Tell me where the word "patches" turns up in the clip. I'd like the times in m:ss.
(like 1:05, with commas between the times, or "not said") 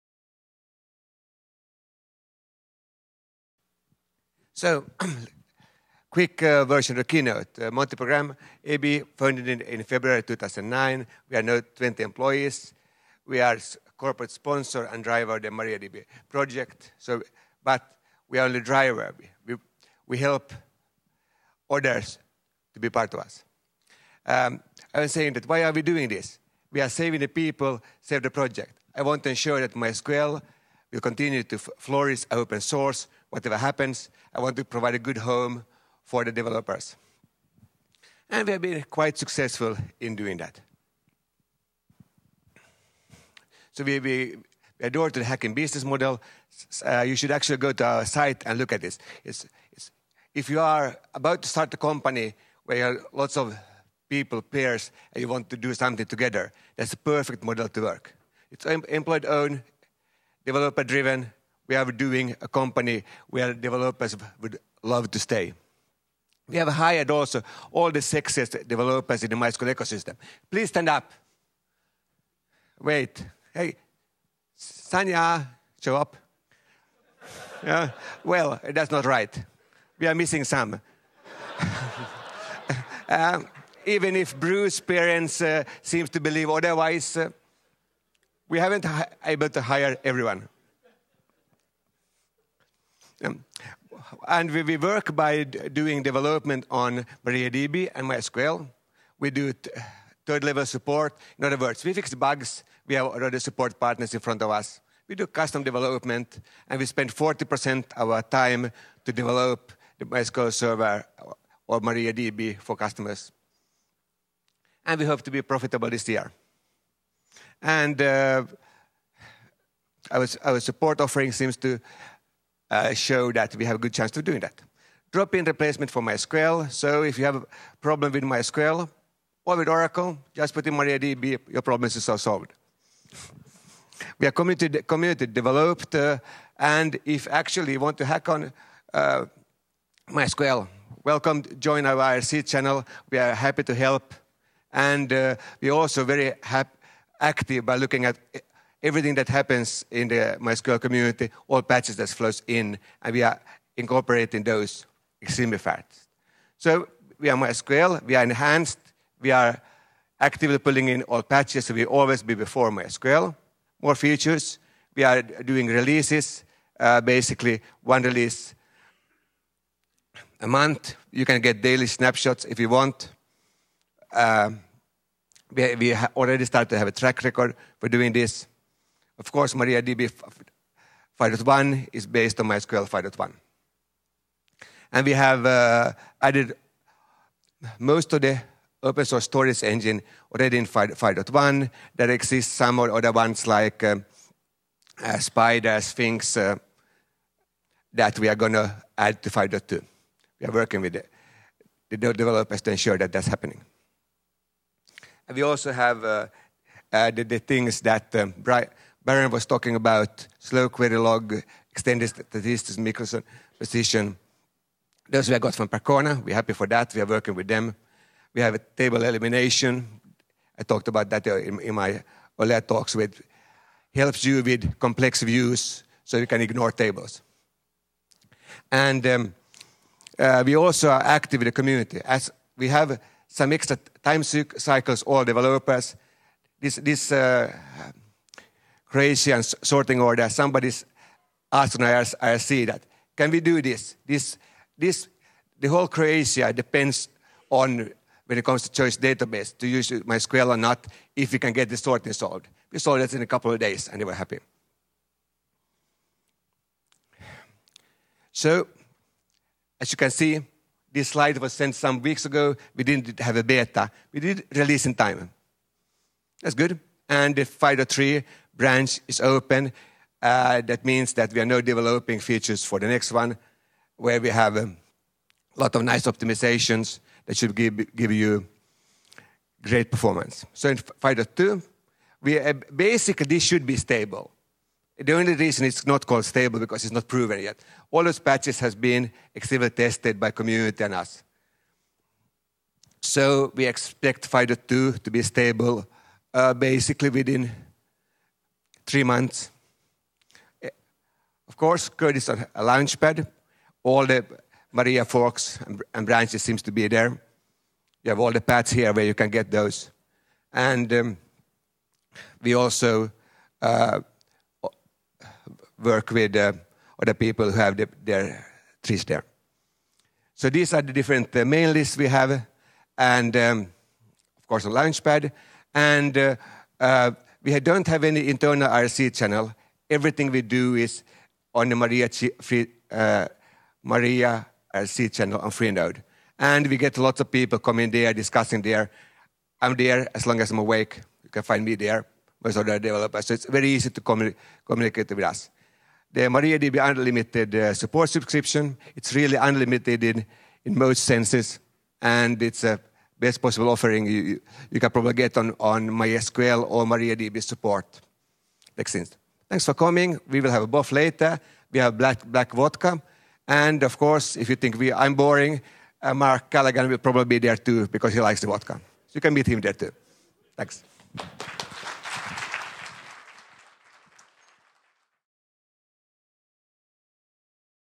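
2:31, 2:41, 4:48.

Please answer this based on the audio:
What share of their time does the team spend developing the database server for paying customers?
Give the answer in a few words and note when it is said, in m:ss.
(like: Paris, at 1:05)
40%, at 1:47.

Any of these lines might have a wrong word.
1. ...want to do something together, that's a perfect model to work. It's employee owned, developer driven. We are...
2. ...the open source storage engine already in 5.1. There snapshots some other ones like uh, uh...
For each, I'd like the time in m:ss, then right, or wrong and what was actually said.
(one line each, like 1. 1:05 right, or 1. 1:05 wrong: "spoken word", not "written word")
1. 0:55 right
2. 3:08 wrong: "exists", not "snapshots".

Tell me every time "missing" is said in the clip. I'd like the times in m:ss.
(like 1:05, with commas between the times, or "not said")
1:20.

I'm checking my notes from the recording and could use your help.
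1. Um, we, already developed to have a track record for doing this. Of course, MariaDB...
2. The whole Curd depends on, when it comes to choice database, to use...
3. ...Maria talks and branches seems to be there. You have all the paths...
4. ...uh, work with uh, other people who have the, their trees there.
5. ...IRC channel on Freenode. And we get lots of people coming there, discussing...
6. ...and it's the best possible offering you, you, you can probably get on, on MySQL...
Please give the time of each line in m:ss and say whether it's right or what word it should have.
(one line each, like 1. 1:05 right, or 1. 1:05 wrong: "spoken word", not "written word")
1. 2:54 wrong: "started", not "developed"
2. 4:05 wrong: "Croatia", not "Curd"
3. 5:04 wrong: "forks", not "talks"
4. 5:13 right
5. 5:34 right
6. 5:52 right.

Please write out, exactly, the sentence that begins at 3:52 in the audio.
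As we have some extra time cycles, all developers.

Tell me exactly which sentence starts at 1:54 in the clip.
And we hope to be profitable this year.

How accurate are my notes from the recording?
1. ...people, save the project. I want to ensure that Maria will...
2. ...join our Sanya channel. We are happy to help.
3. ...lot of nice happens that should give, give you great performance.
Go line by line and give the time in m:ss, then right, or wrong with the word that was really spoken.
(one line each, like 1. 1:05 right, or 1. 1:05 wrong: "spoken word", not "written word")
1. 0:27 wrong: "MySQL", not "Maria"
2. 2:21 wrong: "IRC", not "Sanya"
3. 4:35 wrong: "optimizations", not "happens".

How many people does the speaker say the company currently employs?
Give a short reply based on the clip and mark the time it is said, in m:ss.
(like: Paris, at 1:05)
20, at 0:11.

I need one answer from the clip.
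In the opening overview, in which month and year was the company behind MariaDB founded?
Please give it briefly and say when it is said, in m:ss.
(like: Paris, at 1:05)
February 2009, at 0:09.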